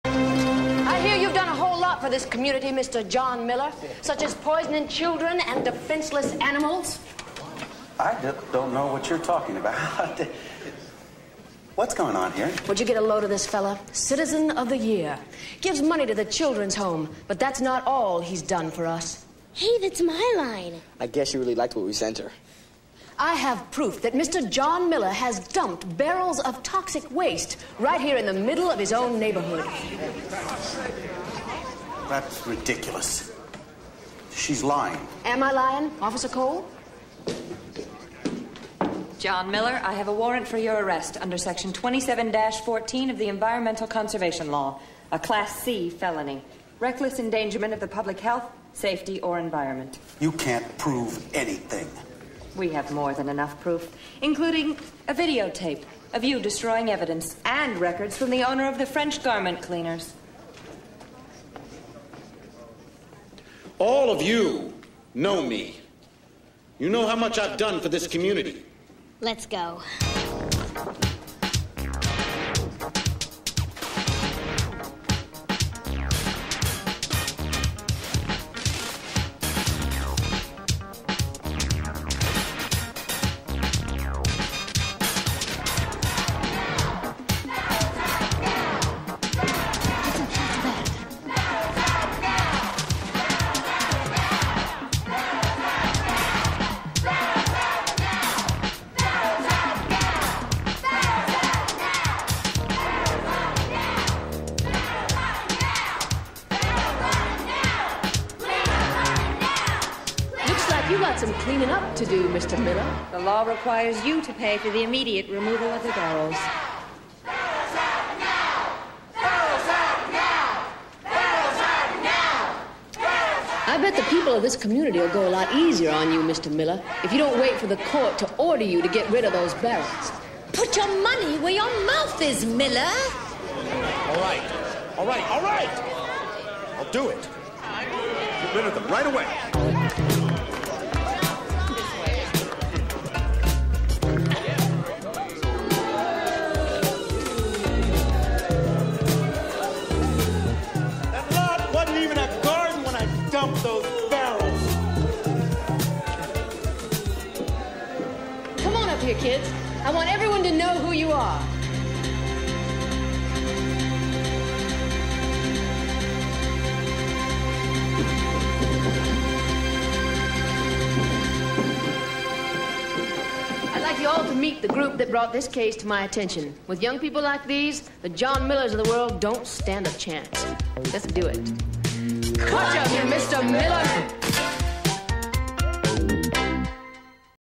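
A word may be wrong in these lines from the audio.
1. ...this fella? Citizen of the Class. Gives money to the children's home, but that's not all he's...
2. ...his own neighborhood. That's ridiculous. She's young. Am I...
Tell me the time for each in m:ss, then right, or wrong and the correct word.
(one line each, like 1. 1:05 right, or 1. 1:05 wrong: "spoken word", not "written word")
1. 0:13 wrong: "Year", not "Class"
2. 0:28 wrong: "lying", not "young".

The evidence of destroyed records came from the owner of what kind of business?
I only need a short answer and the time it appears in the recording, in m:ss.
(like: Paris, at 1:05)
French garment cleaners, at 0:58.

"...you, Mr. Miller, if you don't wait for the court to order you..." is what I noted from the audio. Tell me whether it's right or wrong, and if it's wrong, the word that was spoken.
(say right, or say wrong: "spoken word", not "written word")
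right.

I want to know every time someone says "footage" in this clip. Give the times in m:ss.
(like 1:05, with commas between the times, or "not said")
not said.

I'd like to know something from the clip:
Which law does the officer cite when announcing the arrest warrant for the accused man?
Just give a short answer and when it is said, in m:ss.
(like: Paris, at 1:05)
Environmental Conservation Law, at 0:43.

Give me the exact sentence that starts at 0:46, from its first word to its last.
Reckless endangerment of the public health, safety, or environment.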